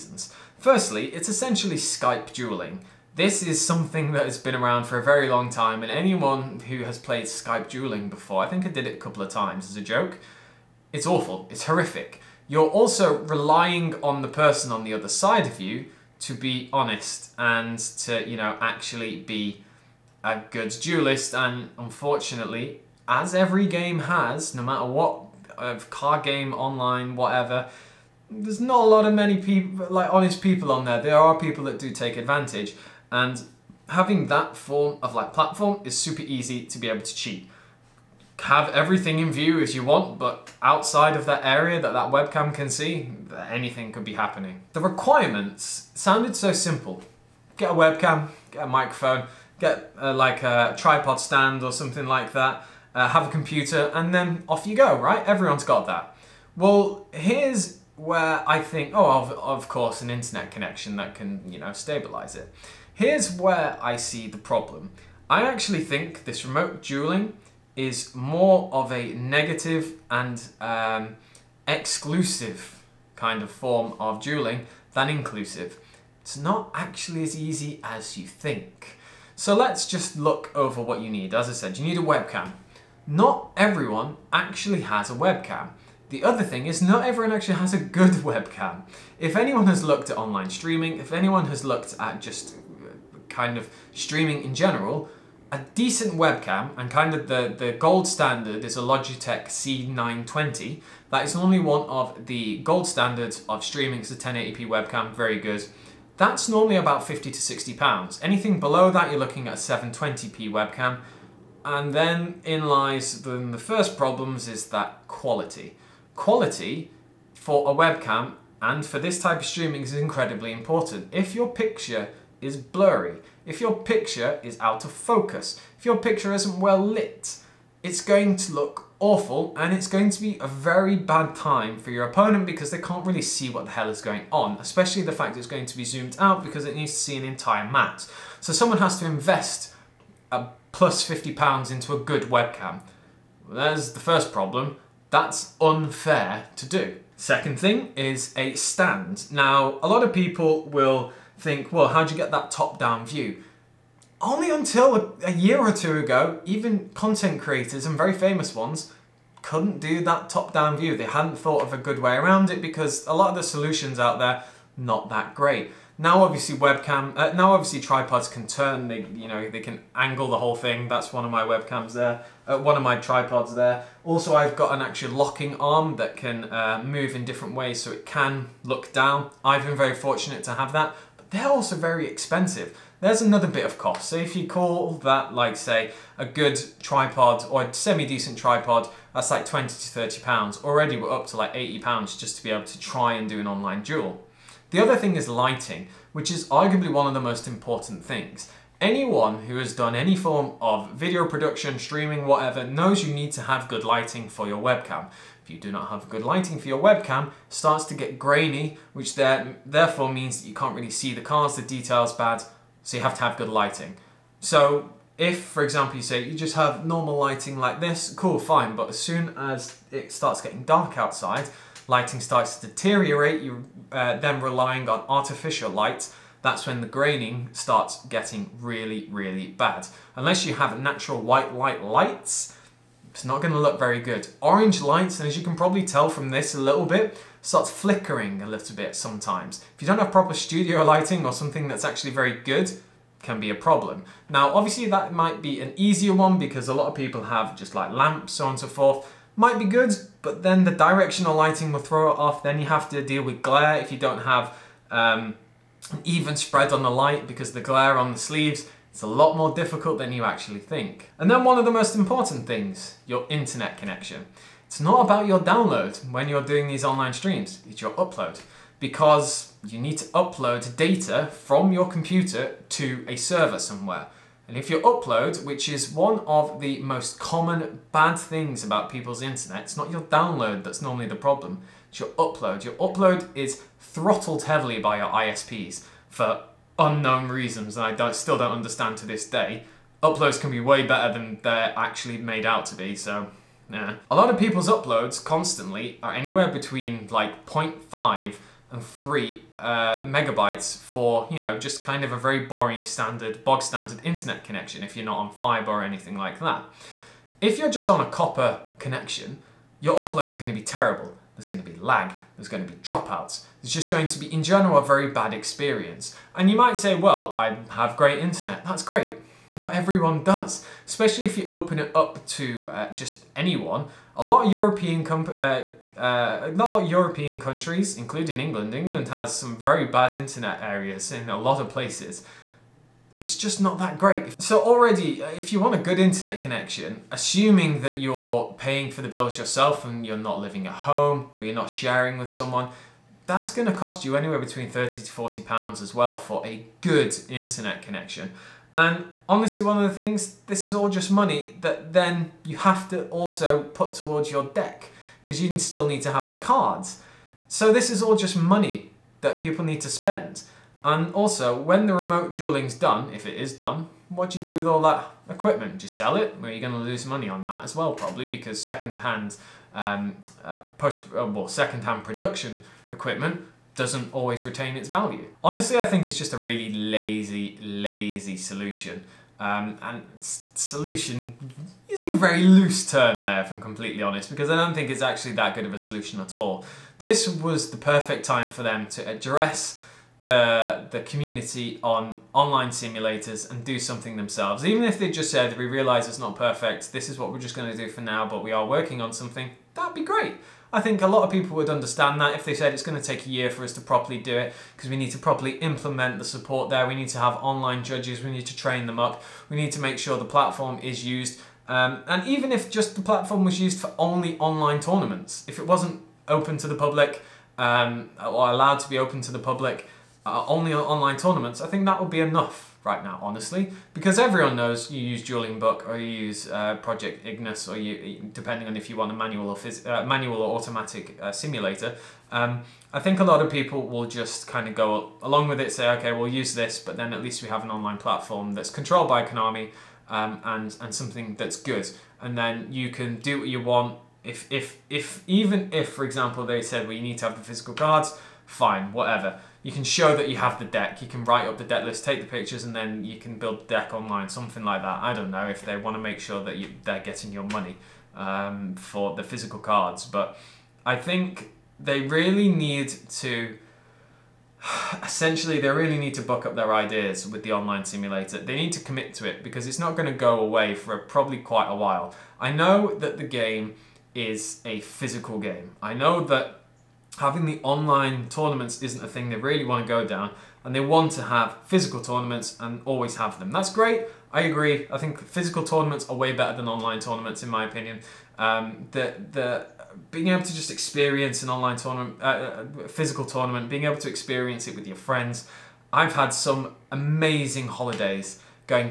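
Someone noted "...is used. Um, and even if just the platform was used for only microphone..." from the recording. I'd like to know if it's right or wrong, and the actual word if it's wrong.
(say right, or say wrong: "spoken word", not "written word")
wrong: "online", not "microphone".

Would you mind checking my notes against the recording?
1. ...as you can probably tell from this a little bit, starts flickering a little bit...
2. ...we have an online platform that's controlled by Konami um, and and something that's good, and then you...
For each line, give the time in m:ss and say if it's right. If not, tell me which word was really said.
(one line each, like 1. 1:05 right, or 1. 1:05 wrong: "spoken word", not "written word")
1. 3:55 right
2. 7:17 right.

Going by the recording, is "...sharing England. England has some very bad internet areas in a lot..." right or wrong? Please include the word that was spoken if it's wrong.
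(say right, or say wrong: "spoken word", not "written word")
wrong: "including", not "sharing".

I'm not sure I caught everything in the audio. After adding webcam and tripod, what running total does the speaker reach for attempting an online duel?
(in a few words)
80 pounds.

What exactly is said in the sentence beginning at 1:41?
That is normally one of the gold standards of streaming.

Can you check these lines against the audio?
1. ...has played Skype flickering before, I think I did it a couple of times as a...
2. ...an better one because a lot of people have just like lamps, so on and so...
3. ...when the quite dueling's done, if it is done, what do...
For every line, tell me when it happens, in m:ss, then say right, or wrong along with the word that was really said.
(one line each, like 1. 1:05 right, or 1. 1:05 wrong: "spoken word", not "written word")
1. 0:06 wrong: "dueling", not "flickering"
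2. 4:05 wrong: "easier", not "better"
3. 6:01 wrong: "remote", not "quite".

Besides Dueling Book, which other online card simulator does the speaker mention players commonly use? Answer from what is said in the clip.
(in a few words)
Project Ignis.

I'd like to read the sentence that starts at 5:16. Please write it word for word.
And you might say, well, I have great internet.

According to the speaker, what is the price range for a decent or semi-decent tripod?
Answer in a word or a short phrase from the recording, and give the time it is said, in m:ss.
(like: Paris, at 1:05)
20 to 30 pounds, at 3:09.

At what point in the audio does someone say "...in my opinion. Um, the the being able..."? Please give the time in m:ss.
8:07.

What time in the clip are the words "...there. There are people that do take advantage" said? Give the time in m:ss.
0:30.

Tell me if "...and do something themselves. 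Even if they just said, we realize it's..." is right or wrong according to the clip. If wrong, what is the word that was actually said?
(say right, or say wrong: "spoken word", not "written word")
right.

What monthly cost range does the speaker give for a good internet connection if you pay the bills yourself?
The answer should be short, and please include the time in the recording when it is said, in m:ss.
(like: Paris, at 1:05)
30 to 40 pounds, at 5:44.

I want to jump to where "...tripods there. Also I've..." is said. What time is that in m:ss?
2:52.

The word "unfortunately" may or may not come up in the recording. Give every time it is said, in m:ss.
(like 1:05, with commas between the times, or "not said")
0:21.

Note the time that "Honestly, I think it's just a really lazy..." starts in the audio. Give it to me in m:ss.
6:15.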